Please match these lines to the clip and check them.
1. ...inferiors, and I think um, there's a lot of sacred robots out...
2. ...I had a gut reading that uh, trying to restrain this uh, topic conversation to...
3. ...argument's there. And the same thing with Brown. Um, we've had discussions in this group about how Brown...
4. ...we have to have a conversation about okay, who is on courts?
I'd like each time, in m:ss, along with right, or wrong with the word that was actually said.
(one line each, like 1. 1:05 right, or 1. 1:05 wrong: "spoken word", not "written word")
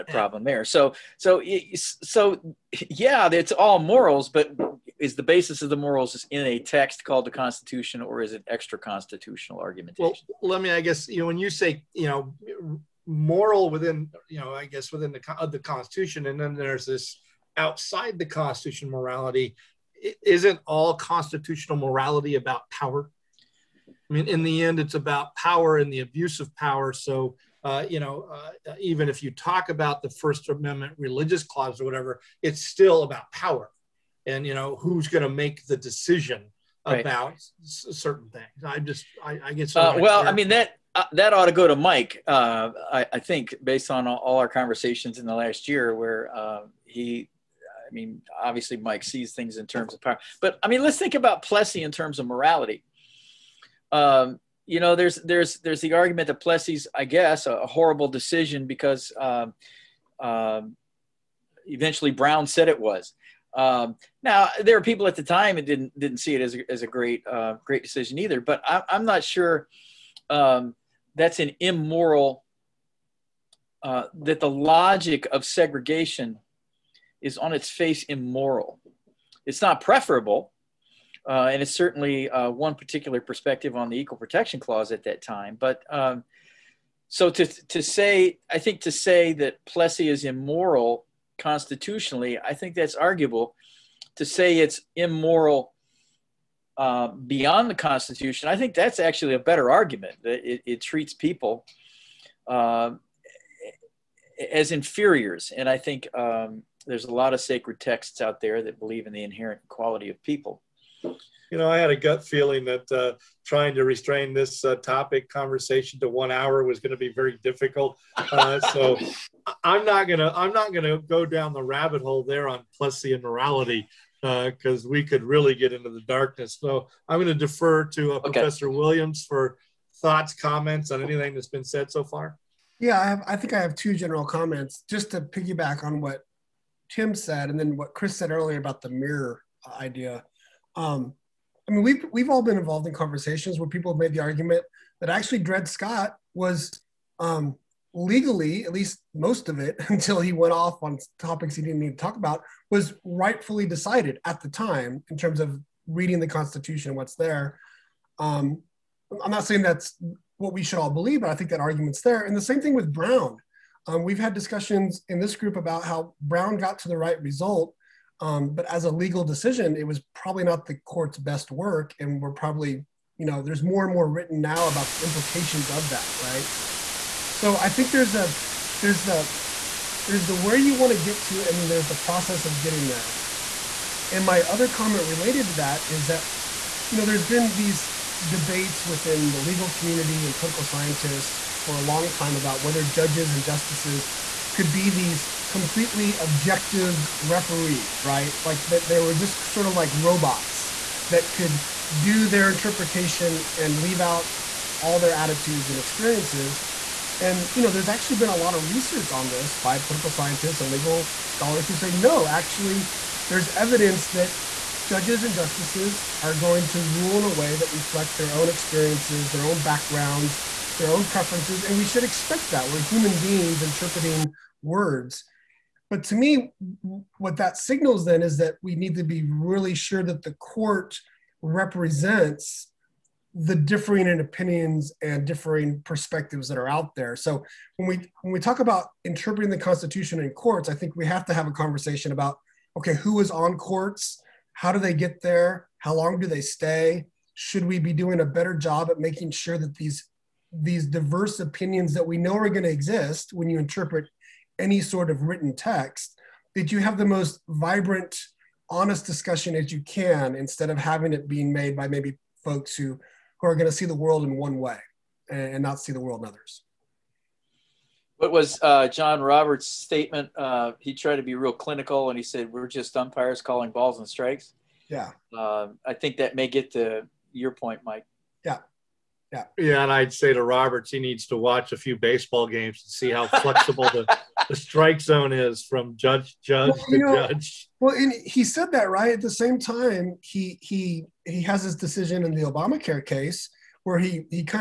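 1. 1:44 wrong: "texts", not "robots"
2. 1:51 wrong: "feeling", not "reading"
3. 2:41 right
4. 4:00 right.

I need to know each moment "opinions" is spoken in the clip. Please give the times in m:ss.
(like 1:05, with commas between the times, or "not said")
3:54, 4:11.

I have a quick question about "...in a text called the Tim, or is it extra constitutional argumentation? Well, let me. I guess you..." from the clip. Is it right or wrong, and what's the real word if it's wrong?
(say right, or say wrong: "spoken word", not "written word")
wrong: "Constitution", not "Tim".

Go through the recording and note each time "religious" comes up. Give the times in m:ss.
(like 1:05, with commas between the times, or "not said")
0:30.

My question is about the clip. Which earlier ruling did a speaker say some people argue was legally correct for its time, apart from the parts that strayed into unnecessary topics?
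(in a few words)
Dred Scott.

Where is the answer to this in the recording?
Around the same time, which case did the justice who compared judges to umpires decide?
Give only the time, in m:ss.
4:52.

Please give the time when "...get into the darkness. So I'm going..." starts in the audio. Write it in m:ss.
2:05.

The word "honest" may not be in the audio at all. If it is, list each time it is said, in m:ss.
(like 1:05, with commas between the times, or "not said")
4:18.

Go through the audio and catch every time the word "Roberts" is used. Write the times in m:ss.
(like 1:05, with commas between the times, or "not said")
4:29, 4:40.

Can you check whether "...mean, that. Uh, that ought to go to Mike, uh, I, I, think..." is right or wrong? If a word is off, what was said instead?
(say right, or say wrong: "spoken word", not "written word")
right.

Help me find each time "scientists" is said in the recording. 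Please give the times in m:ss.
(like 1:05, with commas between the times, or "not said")
3:10, 3:30.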